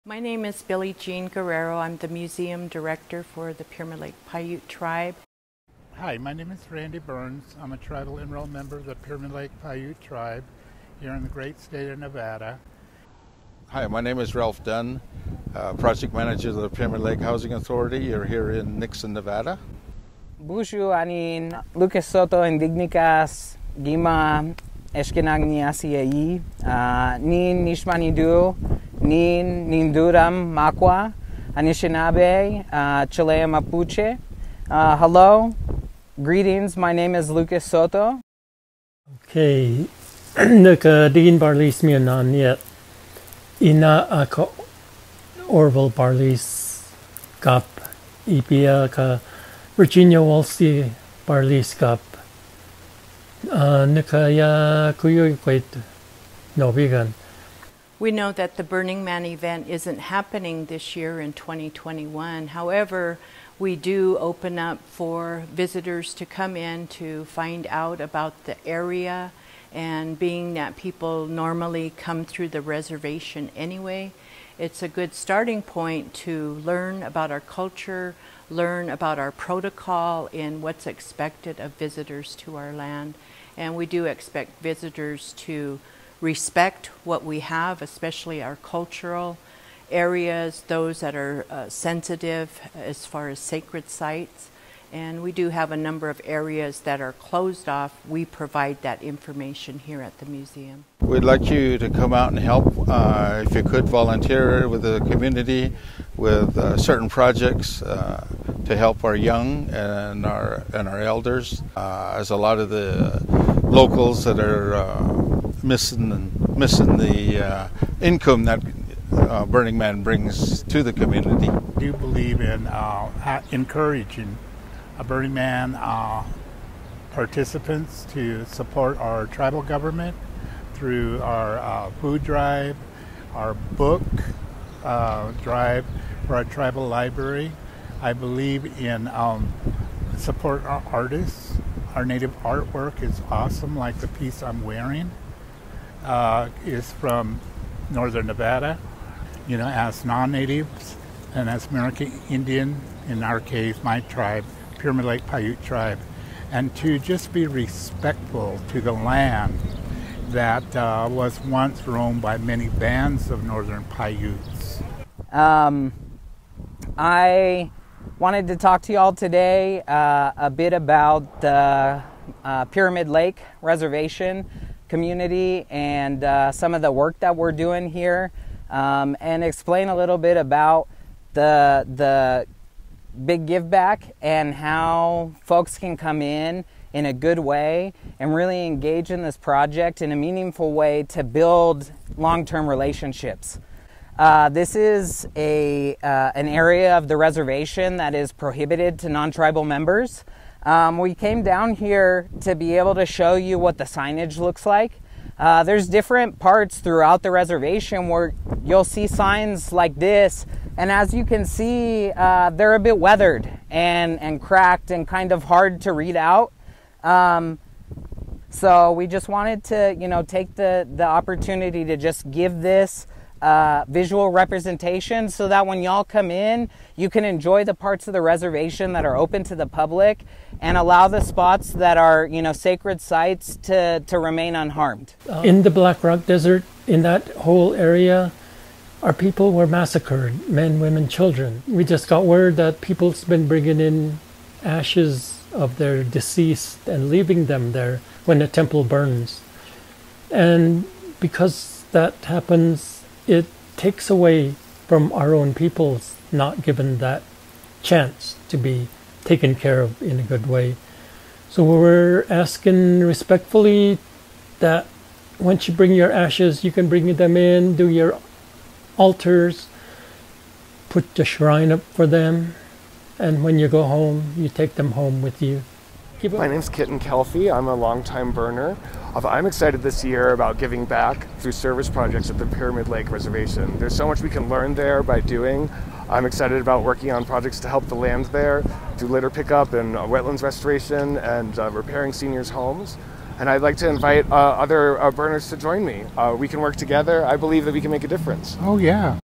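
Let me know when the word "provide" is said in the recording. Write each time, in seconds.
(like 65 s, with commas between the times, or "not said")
98 s.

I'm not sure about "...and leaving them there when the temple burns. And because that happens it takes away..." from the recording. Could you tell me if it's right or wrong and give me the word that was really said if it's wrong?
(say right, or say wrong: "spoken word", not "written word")
right.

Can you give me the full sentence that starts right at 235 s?
Uh, in the Black Rock Desert, in that whole area, our people were massacred men, women, children.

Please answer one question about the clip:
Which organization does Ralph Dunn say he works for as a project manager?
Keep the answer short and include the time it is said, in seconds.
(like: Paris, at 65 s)
Pyramid Lake Housing Authority, at 16 s.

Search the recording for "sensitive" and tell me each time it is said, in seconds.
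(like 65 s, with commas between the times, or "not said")
91 s.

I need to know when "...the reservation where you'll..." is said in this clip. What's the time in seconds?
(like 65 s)
207 s.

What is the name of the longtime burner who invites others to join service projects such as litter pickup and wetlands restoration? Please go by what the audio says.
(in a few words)
Kitten Calfee.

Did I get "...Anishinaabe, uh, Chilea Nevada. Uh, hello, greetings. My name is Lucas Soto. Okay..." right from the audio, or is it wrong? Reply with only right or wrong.
wrong.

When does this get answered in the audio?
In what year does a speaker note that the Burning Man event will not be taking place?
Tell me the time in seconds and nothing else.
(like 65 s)
61 s.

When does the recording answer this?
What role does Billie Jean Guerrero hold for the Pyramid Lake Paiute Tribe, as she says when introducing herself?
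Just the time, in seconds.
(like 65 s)
2 s.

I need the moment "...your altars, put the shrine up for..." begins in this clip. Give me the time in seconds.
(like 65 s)
267 s.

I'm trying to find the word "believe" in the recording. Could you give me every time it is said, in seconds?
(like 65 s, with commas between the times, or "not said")
121 s, 138 s, 297 s.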